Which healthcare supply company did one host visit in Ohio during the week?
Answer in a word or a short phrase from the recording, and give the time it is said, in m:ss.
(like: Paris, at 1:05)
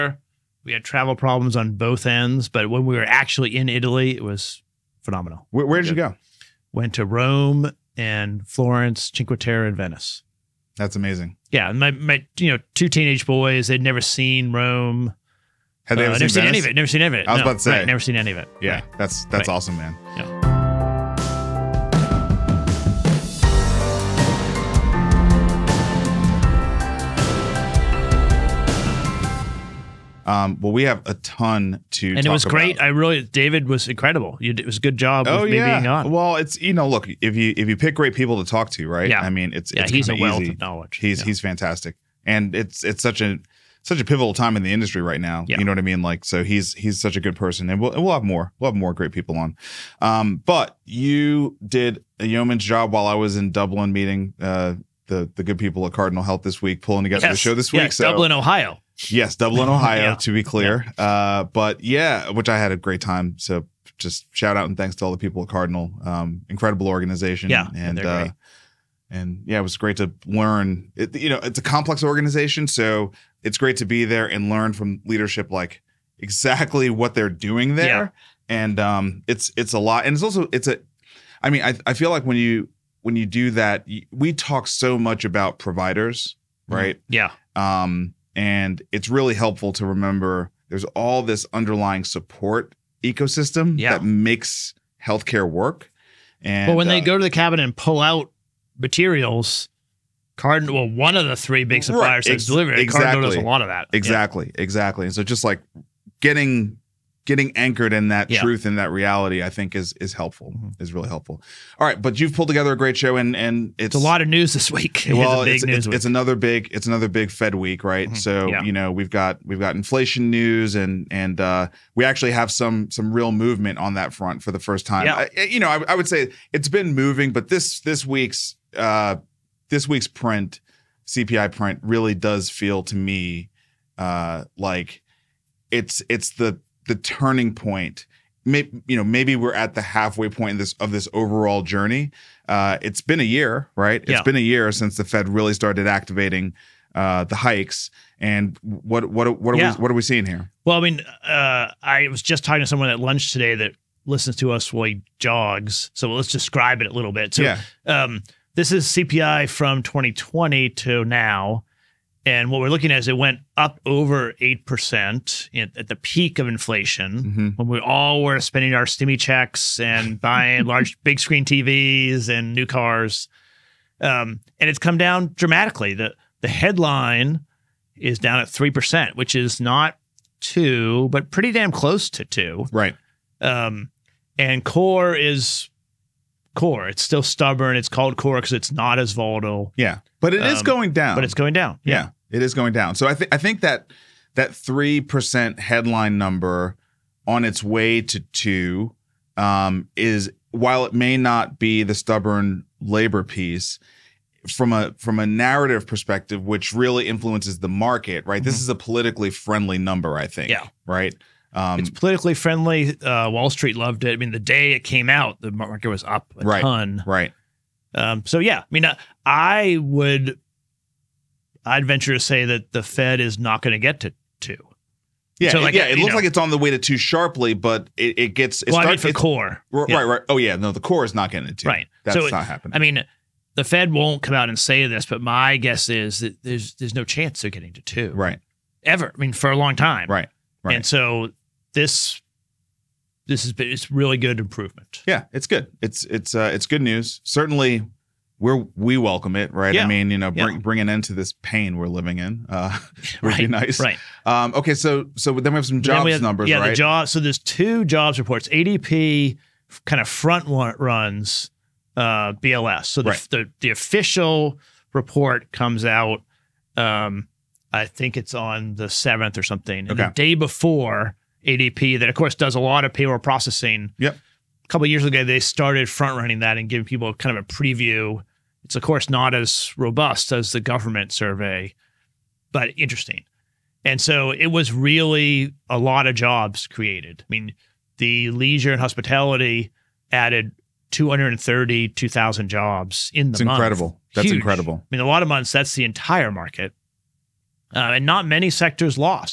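Cardinal Health, at 0:55.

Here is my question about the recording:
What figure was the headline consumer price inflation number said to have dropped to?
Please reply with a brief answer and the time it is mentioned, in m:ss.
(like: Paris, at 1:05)
3%, at 2:58.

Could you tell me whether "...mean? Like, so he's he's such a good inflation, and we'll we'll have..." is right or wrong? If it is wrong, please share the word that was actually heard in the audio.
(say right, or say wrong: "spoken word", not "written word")
wrong: "person", not "inflation".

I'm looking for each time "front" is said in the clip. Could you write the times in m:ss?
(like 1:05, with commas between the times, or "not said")
2:04, 4:20, 4:35.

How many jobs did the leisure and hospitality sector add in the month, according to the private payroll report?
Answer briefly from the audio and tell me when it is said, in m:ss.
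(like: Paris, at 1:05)
232,000, at 4:50.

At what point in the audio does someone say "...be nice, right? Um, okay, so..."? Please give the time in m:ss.
4:13.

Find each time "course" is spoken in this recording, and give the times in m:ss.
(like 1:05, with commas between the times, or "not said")
4:32, 4:38.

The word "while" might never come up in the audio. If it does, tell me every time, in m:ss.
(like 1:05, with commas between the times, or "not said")
0:52, 2:34, 3:20.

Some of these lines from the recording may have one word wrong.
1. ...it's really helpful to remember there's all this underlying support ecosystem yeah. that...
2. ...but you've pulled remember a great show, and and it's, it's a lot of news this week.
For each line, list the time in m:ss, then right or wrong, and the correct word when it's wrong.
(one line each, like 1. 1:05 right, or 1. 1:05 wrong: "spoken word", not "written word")
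1. 1:28 right
2. 1:52 wrong: "together", not "remember".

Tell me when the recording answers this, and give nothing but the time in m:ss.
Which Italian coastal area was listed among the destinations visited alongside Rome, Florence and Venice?
0:09.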